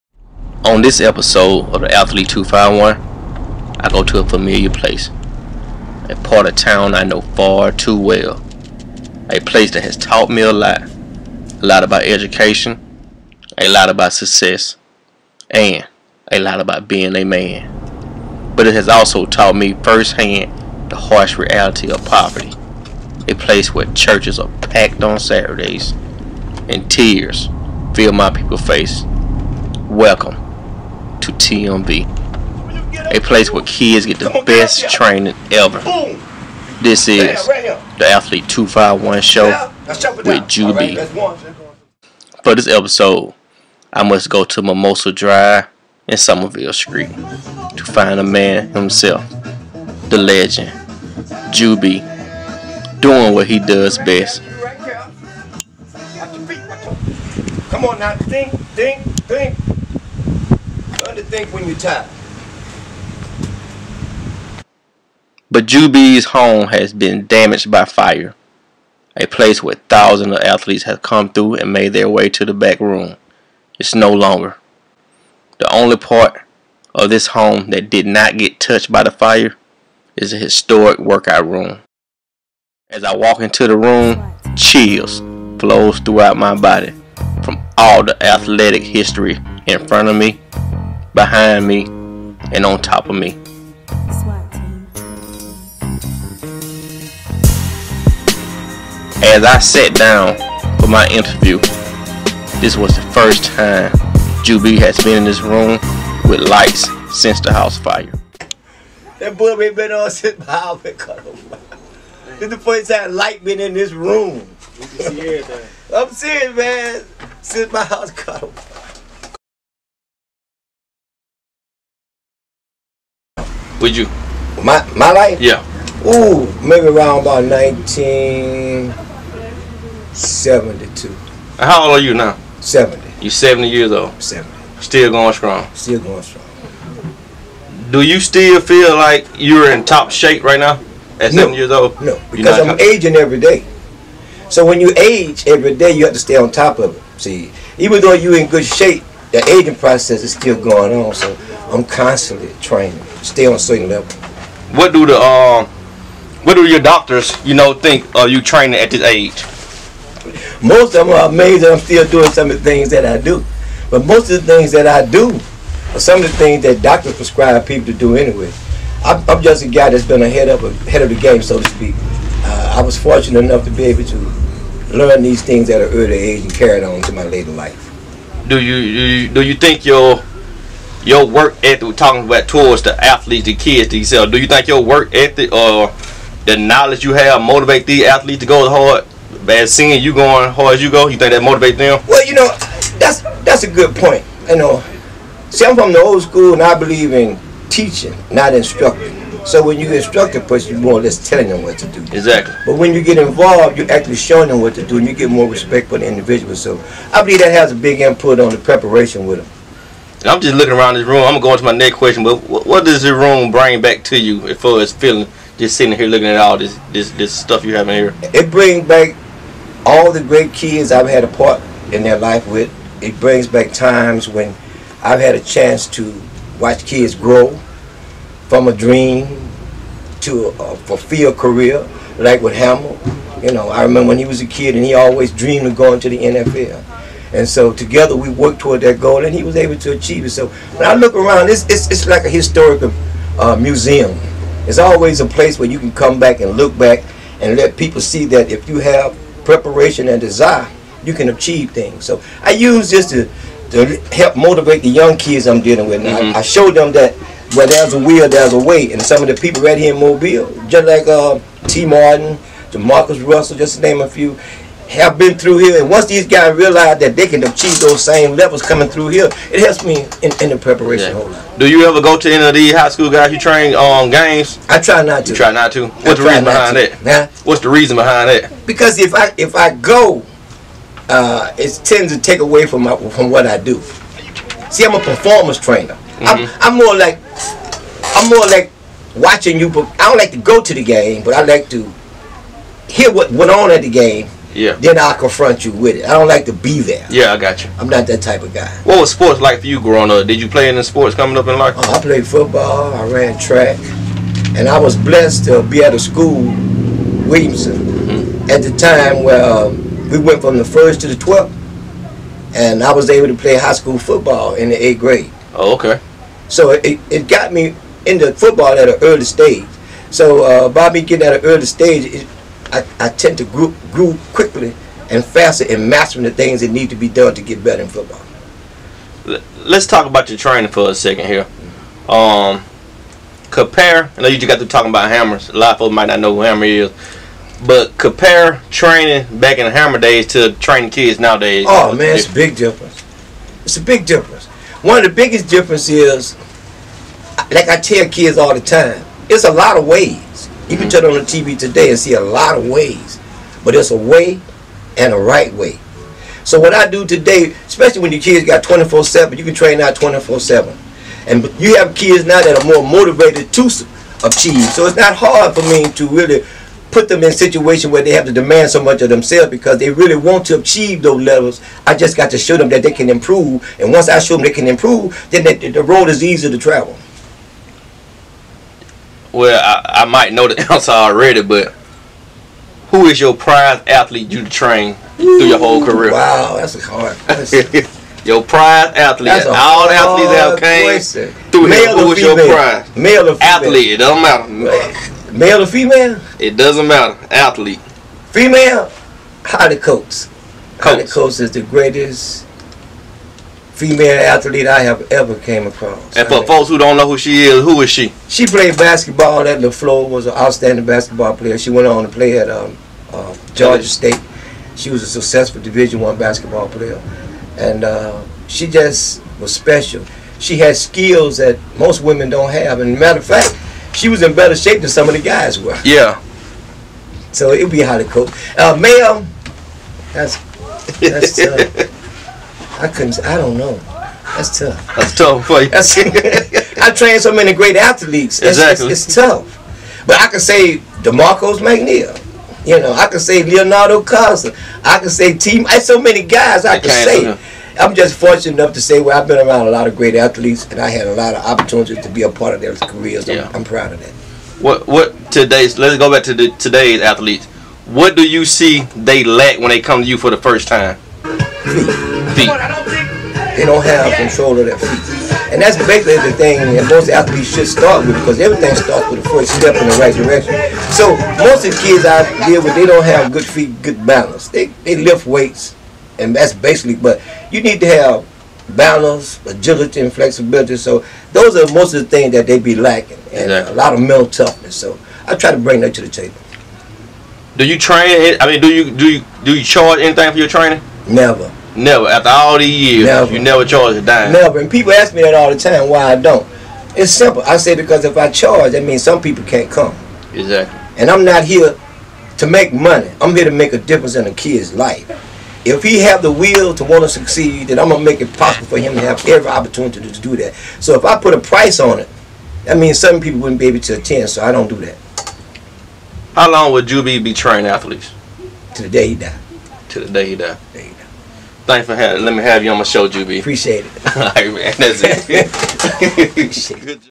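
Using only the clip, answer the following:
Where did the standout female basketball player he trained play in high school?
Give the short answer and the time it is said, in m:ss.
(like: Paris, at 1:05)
LeFlore, at 6:49.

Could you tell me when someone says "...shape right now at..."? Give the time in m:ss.
2:20.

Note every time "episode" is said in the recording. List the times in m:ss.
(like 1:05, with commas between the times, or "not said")
0:01, 0:42.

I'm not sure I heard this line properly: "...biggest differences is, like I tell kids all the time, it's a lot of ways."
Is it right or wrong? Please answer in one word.
right.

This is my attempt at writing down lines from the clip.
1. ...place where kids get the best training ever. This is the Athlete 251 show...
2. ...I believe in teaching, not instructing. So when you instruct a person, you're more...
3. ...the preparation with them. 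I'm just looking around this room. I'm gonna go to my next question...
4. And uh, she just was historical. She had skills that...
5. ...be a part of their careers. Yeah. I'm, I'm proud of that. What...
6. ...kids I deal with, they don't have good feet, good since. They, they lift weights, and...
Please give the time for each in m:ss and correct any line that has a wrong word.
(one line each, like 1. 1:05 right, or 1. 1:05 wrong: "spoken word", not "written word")
1. 0:33 right
2. 3:16 right
3. 3:28 right
4. 6:57 wrong: "special", not "historical"
5. 7:32 right
6. 7:51 wrong: "balance", not "since".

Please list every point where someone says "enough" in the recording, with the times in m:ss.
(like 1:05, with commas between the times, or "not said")
2:53, 7:28.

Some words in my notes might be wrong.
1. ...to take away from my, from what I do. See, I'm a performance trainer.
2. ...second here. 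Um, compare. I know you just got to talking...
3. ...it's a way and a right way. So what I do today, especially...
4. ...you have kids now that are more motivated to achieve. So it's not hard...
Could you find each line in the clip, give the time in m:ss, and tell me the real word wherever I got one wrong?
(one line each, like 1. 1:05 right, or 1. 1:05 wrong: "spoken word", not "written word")
1. 4:42 right
2. 5:30 right
3. 5:53 right
4. 6:01 right.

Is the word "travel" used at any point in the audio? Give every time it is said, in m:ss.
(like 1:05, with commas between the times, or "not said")
6:16.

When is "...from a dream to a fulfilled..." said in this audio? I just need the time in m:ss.
3:48.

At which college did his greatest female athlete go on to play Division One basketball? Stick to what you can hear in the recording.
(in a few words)
Georgia State.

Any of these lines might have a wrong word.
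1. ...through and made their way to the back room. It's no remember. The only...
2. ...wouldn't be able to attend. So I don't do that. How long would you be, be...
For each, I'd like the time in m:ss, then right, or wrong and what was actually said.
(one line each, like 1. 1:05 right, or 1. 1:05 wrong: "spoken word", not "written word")
1. 1:11 wrong: "longer", not "remember"
2. 8:33 right.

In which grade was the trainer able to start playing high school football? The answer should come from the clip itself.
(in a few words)
8th grade.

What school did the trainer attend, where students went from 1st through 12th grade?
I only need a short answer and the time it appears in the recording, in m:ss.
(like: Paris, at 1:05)
Williamson, at 5:07.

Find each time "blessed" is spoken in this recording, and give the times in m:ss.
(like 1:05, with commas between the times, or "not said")
5:04.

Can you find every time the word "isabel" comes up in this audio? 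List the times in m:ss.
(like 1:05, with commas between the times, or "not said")
not said.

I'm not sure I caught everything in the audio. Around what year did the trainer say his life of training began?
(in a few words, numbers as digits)
1972.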